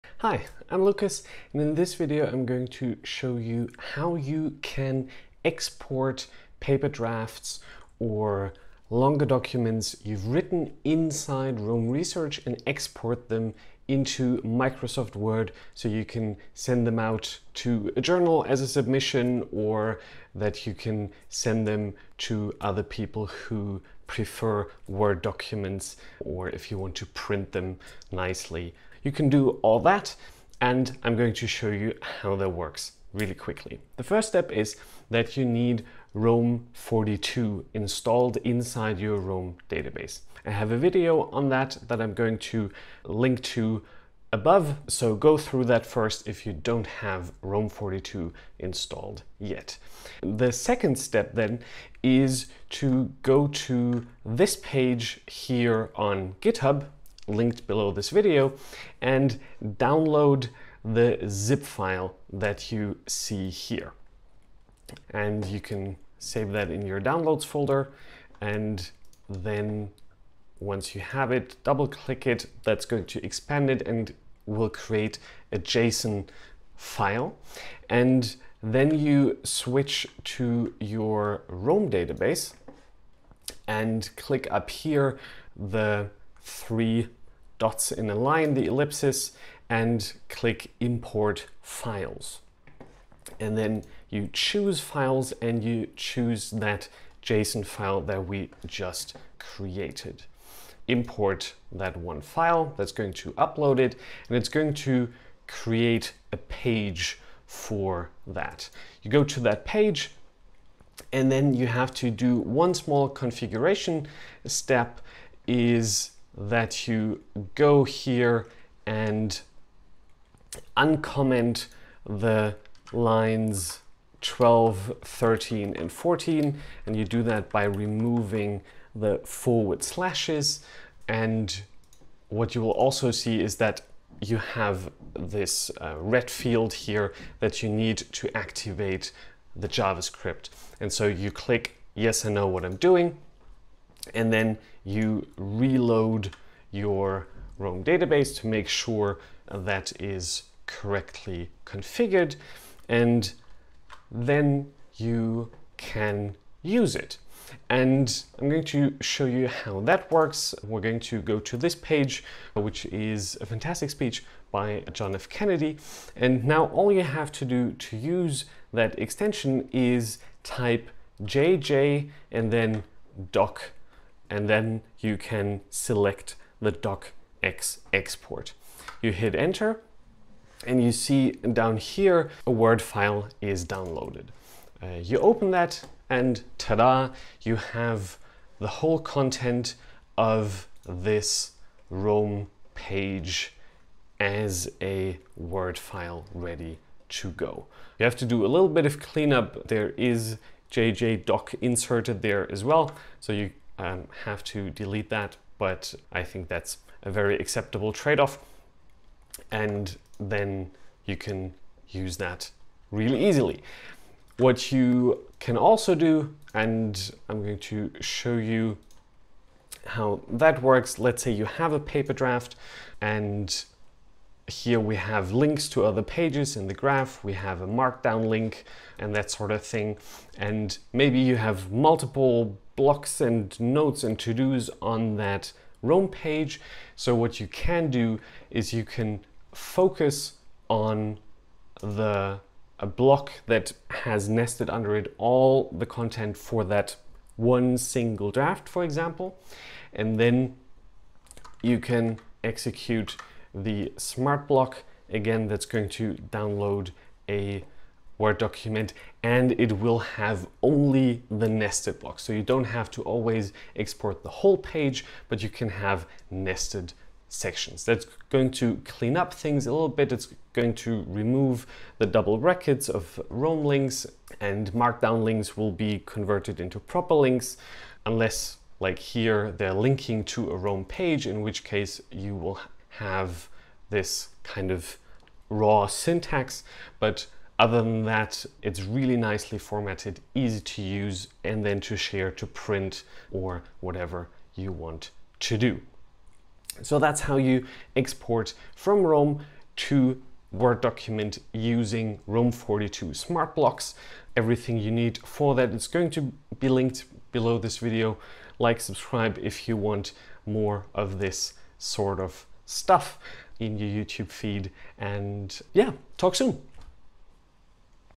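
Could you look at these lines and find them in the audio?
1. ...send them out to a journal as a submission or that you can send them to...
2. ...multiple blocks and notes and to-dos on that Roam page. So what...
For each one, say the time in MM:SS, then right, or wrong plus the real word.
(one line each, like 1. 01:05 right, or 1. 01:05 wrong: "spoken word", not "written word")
1. 00:16 right
2. 03:51 right.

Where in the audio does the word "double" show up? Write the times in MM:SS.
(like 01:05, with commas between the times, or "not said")
01:11, 04:32.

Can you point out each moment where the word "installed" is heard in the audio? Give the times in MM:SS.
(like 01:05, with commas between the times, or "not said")
00:37, 00:48.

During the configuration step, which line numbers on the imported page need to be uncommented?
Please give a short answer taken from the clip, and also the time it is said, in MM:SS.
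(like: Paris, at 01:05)
12, 13, and 14, at 02:04.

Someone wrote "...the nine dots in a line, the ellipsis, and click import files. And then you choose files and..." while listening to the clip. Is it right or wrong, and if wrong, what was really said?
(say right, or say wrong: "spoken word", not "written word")
wrong: "three", not "nine".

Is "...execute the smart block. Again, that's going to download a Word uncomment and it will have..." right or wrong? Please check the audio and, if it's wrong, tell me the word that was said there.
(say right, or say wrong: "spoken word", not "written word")
wrong: "document", not "uncomment".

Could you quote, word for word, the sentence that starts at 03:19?
There is JJ doc inserted there as well.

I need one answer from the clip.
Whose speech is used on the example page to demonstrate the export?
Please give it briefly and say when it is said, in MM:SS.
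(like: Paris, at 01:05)
John F. Kennedy, at 02:44.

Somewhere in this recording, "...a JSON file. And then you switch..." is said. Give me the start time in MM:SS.
01:15.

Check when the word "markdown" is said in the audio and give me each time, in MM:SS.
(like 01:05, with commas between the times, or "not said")
03:47, 04:34.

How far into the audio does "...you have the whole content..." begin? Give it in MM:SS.
03:07.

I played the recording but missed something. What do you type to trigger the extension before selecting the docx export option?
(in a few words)
JJ doc.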